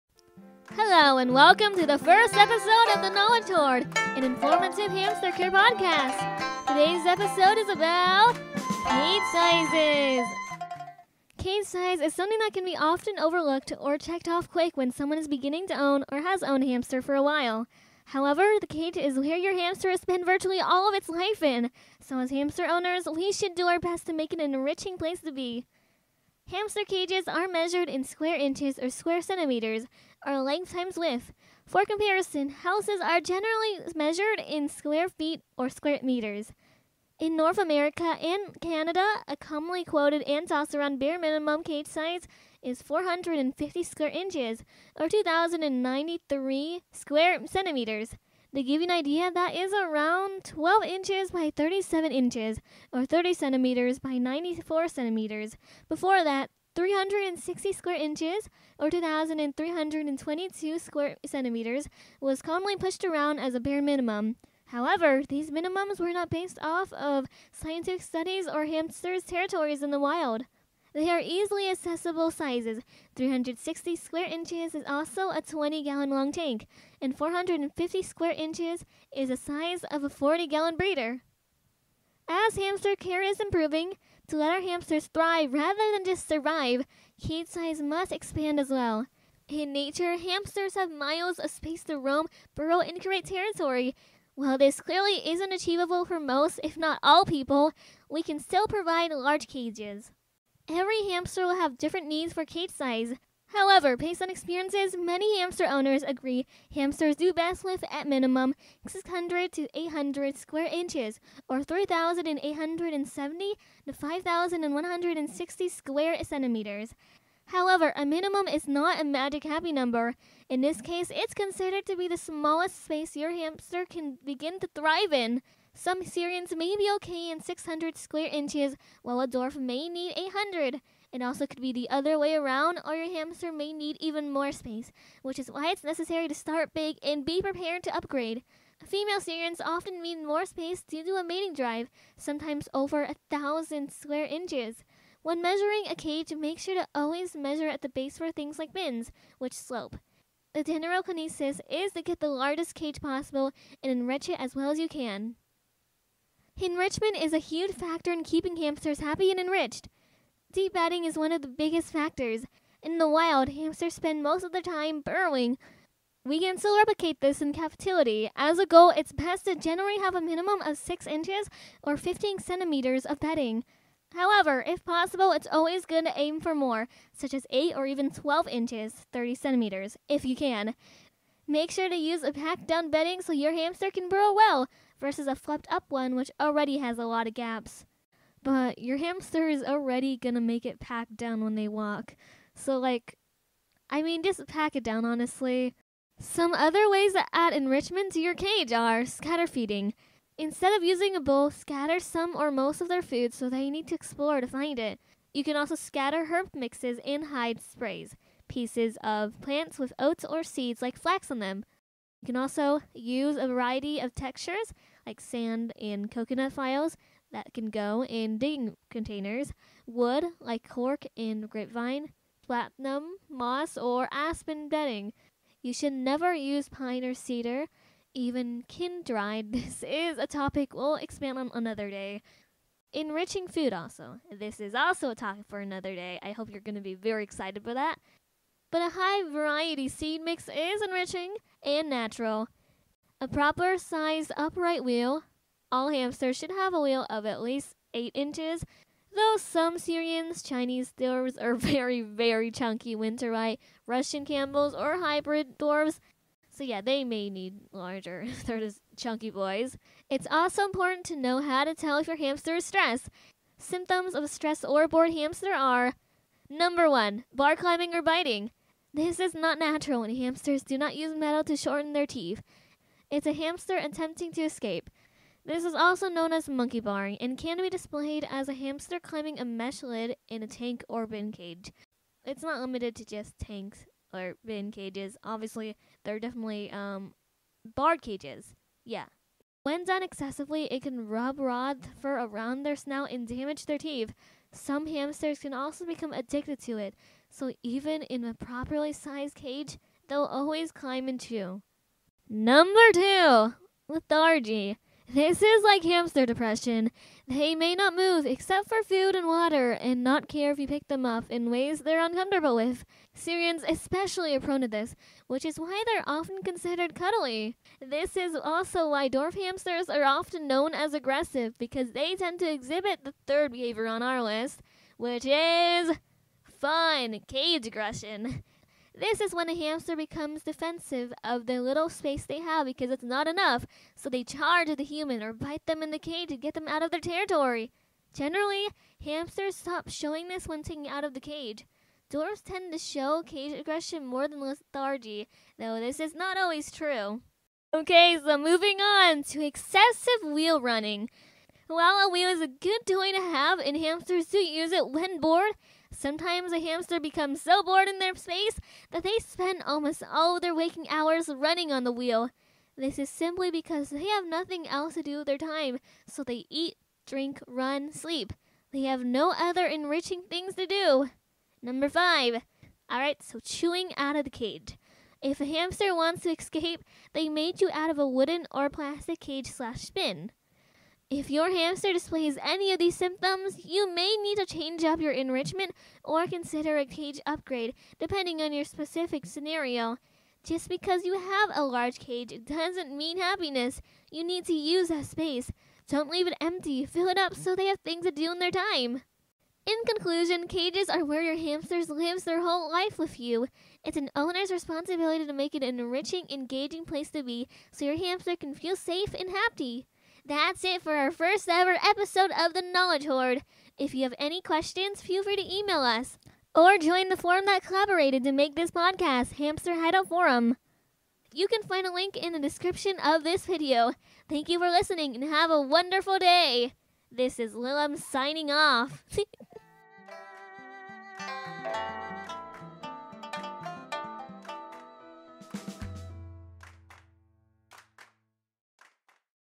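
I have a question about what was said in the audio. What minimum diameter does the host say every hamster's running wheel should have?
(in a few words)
8 inches.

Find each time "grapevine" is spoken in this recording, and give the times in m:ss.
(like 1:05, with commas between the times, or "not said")
3:41.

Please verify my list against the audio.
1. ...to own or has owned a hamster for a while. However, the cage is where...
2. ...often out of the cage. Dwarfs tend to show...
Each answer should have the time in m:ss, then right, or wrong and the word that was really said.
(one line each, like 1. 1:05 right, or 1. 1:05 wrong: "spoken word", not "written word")
1. 0:15 right
2. 5:40 wrong: "taken", not "often".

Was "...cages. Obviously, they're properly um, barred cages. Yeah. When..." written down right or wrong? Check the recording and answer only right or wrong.
wrong.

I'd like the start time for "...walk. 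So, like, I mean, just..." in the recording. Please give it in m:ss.
3:11.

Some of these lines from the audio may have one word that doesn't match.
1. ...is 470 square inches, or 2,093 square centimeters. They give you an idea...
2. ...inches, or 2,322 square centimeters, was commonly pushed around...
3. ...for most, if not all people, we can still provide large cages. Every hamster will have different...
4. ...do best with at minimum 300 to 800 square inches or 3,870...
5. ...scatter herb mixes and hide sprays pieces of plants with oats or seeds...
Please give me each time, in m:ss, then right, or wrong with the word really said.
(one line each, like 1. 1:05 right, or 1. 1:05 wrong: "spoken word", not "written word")
1. 0:42 wrong: "450", not "470"
2. 0:57 right
3. 1:36 right
4. 1:47 wrong: "600", not "300"
5. 3:25 right.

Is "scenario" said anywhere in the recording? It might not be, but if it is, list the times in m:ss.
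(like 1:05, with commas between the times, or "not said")
6:29.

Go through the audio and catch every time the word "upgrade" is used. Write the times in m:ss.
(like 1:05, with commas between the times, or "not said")
2:17, 6:27.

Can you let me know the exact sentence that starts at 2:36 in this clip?
Enrichment is a huge factor in keeping hamsters happy and enriched.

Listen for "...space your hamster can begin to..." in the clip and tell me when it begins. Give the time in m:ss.
2:02.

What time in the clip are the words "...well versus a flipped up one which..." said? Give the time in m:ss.
3:04.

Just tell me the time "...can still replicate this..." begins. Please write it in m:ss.
2:46.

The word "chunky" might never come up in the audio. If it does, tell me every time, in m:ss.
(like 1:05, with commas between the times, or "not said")
4:12, 4:18.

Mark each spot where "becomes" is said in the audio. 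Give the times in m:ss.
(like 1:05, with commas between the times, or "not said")
4:55, 5:29, 5:57.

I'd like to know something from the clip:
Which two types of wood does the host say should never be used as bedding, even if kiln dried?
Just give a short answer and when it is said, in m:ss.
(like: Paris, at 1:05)
Pine or cedar, at 3:46.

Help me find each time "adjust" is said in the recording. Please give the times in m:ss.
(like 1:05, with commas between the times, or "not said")
not said.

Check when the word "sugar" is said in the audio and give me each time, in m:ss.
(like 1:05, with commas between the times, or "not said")
not said.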